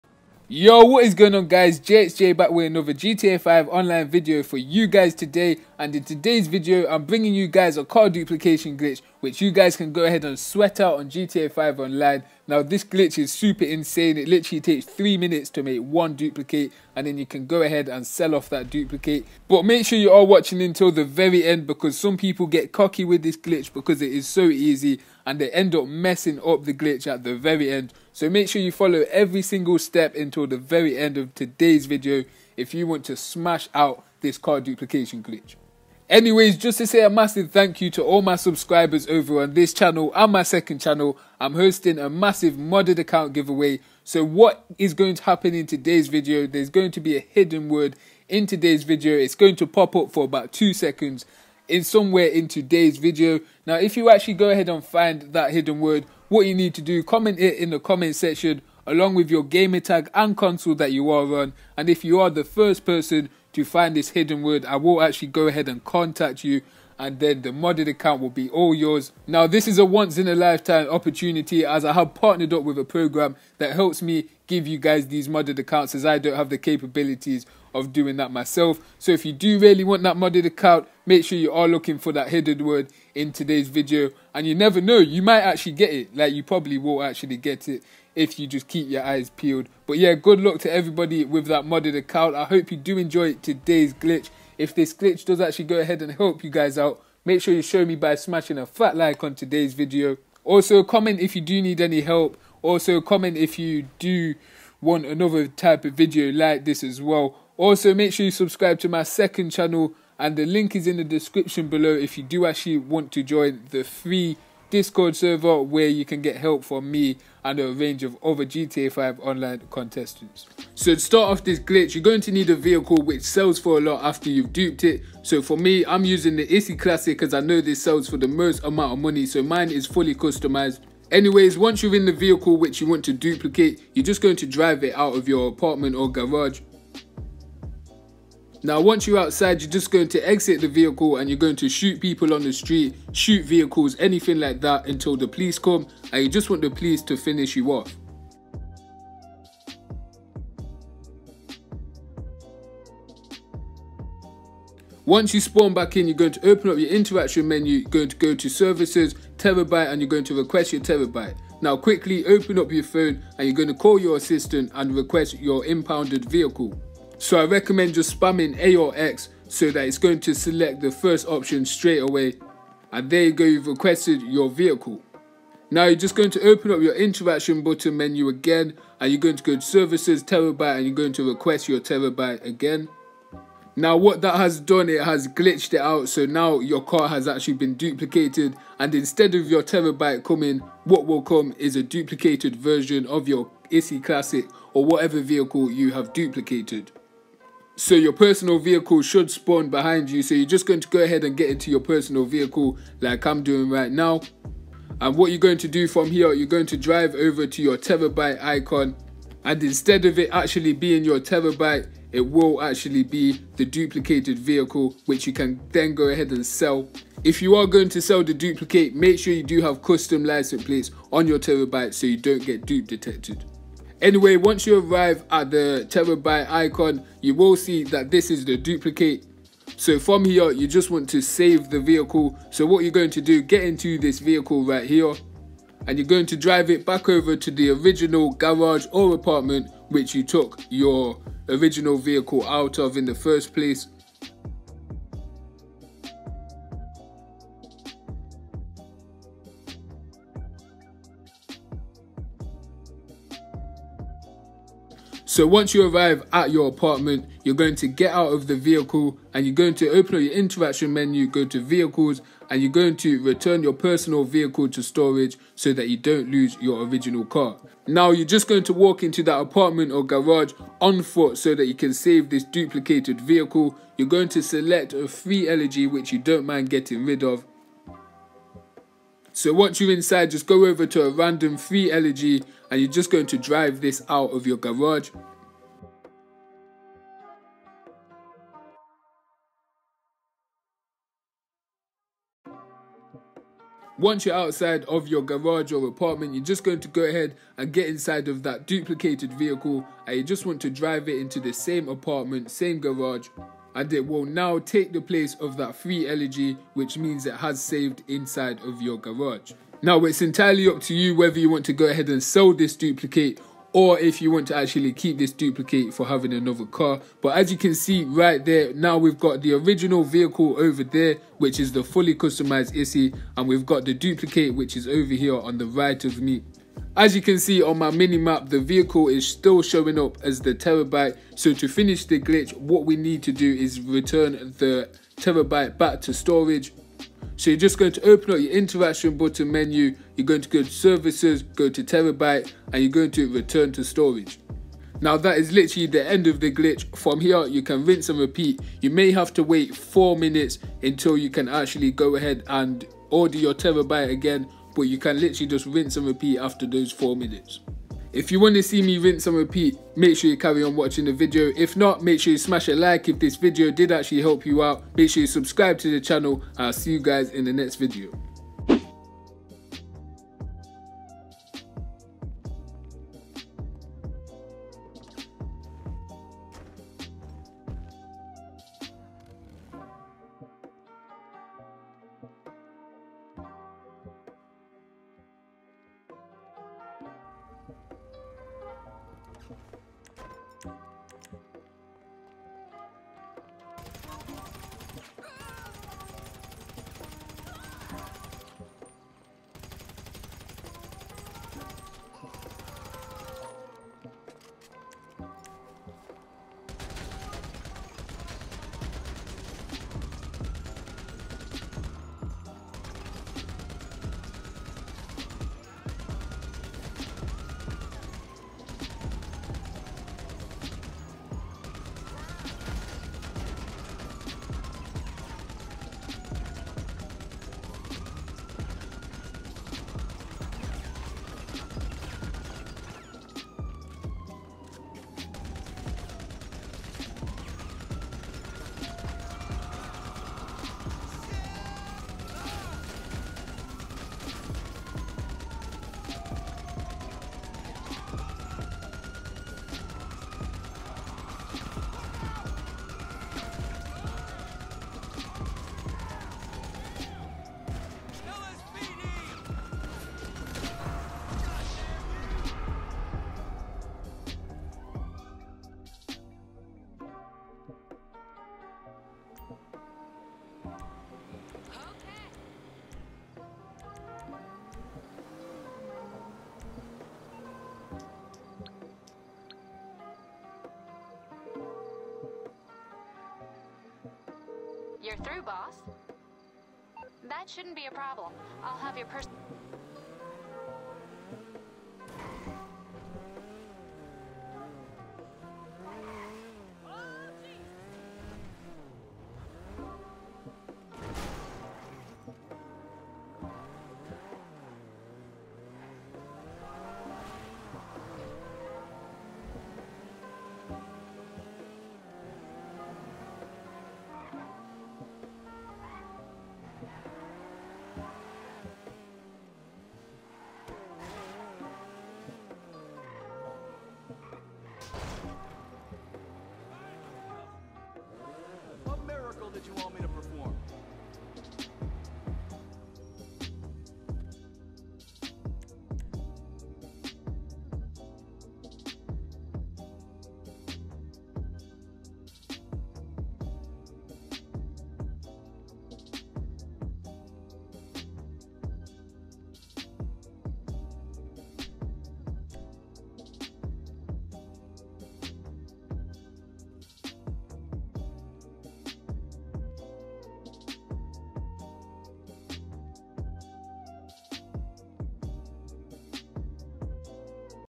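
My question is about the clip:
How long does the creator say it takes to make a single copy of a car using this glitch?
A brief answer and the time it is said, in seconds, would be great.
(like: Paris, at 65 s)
3 minutes, at 14 s.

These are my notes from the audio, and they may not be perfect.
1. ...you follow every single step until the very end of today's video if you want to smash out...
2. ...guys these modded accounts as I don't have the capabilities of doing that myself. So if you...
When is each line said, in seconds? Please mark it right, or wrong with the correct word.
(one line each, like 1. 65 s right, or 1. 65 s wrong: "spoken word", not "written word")
1. 28 s right
2. 74 s right.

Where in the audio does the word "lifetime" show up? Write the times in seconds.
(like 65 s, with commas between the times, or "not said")
70 s.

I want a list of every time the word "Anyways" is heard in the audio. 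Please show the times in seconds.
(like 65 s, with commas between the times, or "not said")
36 s, 131 s, 224 s.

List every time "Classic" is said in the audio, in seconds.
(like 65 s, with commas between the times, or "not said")
126 s, 194 s.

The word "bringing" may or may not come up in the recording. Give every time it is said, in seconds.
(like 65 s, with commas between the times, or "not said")
7 s.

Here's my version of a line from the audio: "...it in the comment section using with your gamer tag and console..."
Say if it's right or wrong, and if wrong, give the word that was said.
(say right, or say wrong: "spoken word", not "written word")
wrong: "along", not "using".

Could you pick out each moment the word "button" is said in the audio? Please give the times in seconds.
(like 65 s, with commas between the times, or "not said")
177 s, 339 s.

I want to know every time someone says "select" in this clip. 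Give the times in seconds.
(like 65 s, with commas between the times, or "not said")
170 s, 274 s.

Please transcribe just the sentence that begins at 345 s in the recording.
Now that is literally the end of the glitch.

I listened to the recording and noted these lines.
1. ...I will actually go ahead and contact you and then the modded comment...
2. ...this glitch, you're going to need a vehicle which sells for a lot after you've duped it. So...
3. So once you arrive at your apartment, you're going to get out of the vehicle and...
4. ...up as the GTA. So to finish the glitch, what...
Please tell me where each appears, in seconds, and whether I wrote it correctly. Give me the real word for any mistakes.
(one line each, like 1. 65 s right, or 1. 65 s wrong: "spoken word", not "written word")
1. 64 s wrong: "account", not "comment"
2. 121 s right
3. 255 s right
4. 329 s wrong: "Terrorbyte", not "GTA".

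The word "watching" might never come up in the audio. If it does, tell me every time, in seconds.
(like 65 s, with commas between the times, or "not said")
20 s, 360 s.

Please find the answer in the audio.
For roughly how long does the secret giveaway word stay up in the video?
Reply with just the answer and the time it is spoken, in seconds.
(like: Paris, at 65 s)
2 seconds, at 50 s.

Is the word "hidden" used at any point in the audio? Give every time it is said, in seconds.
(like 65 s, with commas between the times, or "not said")
47 s, 55 s, 64 s, 82 s.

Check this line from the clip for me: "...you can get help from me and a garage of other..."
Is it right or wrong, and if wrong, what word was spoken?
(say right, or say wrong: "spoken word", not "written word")
wrong: "range", not "garage".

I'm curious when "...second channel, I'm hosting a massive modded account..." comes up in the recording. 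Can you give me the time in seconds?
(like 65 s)
40 s.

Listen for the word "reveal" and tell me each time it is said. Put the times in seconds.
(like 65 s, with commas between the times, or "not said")
not said.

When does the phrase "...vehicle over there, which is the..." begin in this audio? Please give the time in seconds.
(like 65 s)
320 s.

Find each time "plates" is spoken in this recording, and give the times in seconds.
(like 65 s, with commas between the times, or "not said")
220 s.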